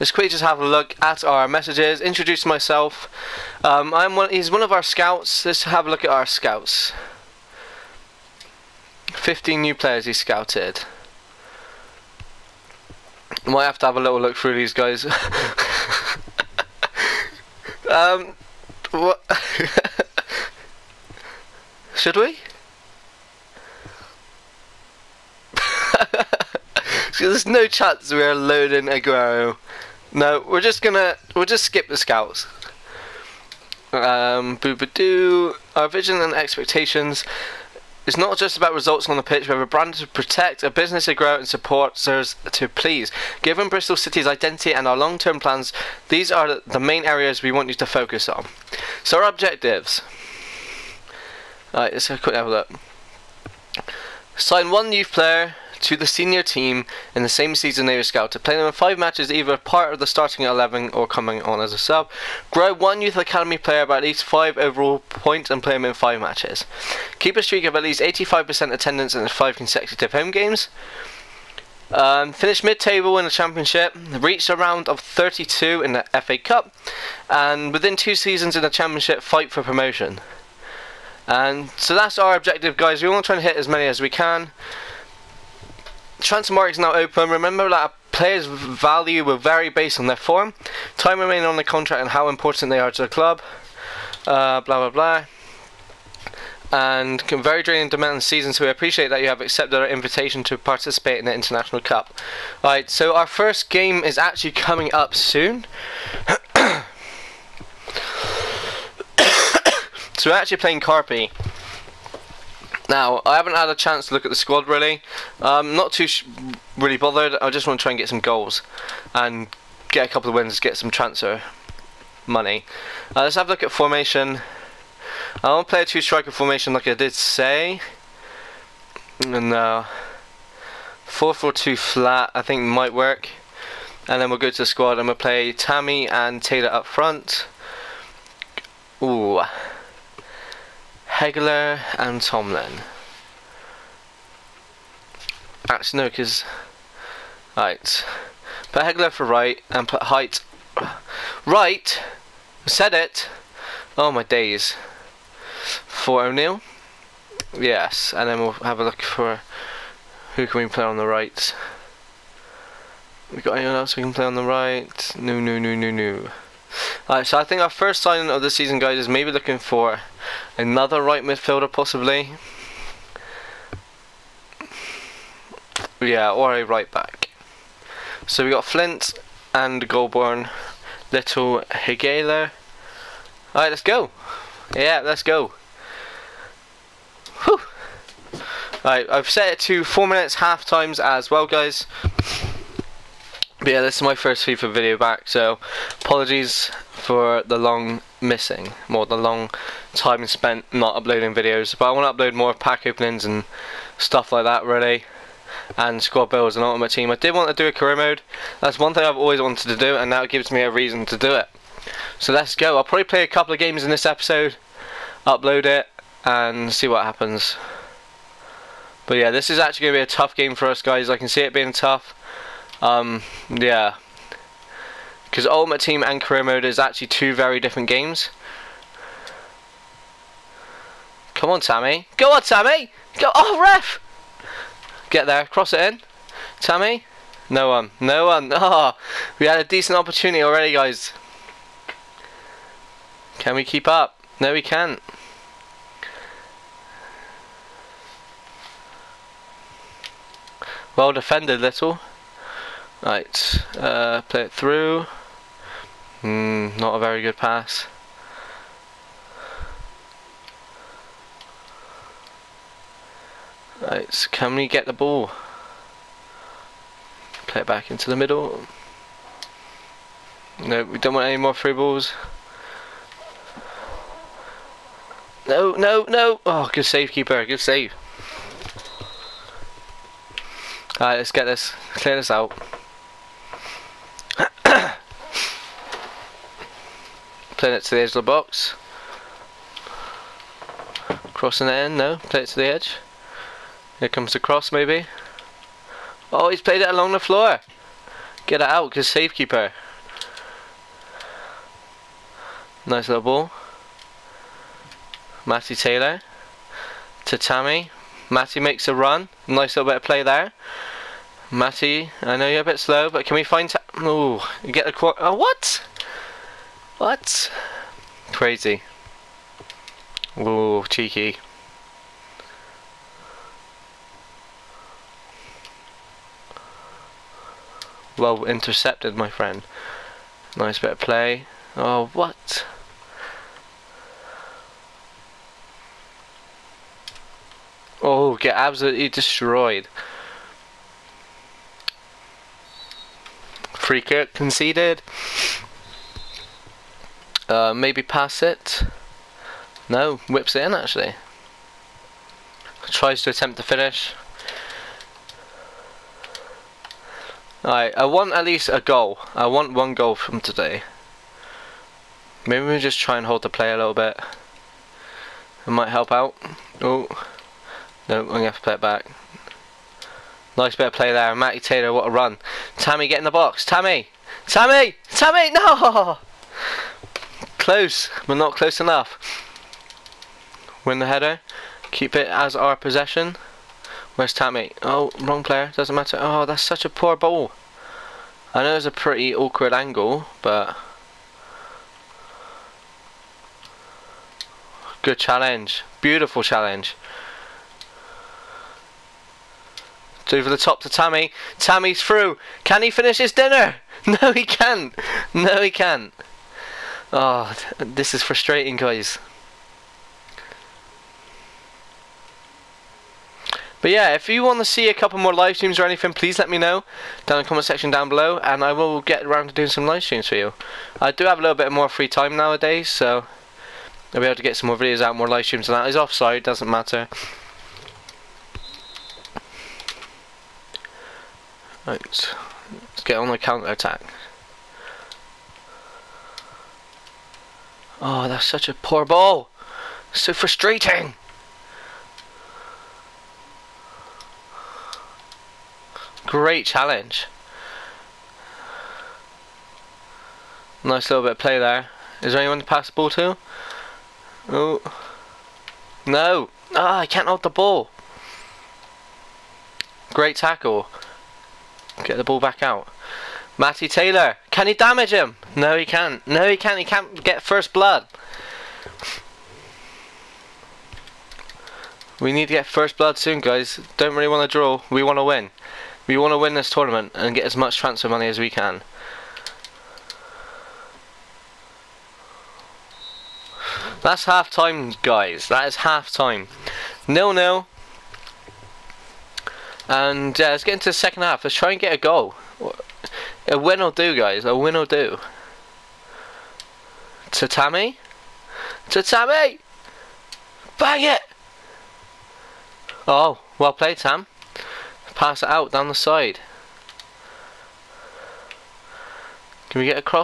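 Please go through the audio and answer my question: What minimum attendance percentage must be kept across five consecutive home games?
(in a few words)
85%.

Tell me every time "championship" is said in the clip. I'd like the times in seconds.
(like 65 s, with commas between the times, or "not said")
73 s, 78 s.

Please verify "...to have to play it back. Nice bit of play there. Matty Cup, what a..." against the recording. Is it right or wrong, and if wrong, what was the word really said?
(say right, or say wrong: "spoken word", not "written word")
wrong: "Taylor", not "Cup".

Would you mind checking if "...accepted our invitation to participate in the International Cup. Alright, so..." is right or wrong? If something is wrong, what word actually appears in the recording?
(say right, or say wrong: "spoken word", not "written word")
right.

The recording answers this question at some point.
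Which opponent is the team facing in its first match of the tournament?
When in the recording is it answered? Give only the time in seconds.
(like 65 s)
110 s.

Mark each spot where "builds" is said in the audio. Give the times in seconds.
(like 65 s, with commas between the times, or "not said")
206 s.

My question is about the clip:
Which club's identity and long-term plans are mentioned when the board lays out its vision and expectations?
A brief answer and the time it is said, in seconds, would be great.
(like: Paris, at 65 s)
Bristol City, at 43 s.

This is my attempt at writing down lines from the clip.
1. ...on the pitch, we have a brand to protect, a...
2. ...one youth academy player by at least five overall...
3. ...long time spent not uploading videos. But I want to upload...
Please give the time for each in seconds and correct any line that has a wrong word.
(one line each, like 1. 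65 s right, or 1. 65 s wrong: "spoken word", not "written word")
1. 39 s right
2. 62 s right
3. 199 s right.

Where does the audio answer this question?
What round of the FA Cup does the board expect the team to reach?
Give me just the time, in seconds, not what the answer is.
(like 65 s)
74 s.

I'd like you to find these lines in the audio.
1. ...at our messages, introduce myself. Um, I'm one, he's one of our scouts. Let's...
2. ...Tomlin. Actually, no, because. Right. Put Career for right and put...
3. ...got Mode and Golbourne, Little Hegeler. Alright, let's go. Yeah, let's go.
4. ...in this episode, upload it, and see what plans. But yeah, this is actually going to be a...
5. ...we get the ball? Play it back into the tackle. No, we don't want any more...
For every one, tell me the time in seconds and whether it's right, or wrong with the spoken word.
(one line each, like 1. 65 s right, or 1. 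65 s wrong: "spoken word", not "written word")
1. 0 s right
2. 142 s wrong: "Hegeler", not "Career"
3. 178 s wrong: "Flint", not "Mode"
4. 213 s wrong: "happens", not "plans"
5. 264 s wrong: "middle", not "tackle".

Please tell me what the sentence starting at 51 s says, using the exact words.
Alright, let's have a quick have a look.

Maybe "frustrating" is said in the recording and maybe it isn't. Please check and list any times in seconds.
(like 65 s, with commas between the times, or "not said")
408 s, 440 s.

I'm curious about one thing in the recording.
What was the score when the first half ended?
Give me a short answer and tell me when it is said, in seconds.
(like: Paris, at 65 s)
0-0, at 487 s.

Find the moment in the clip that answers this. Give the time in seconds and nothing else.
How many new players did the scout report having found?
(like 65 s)
9 s.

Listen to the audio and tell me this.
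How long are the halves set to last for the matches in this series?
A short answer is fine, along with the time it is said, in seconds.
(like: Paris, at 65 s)
4 minutes, at 189 s.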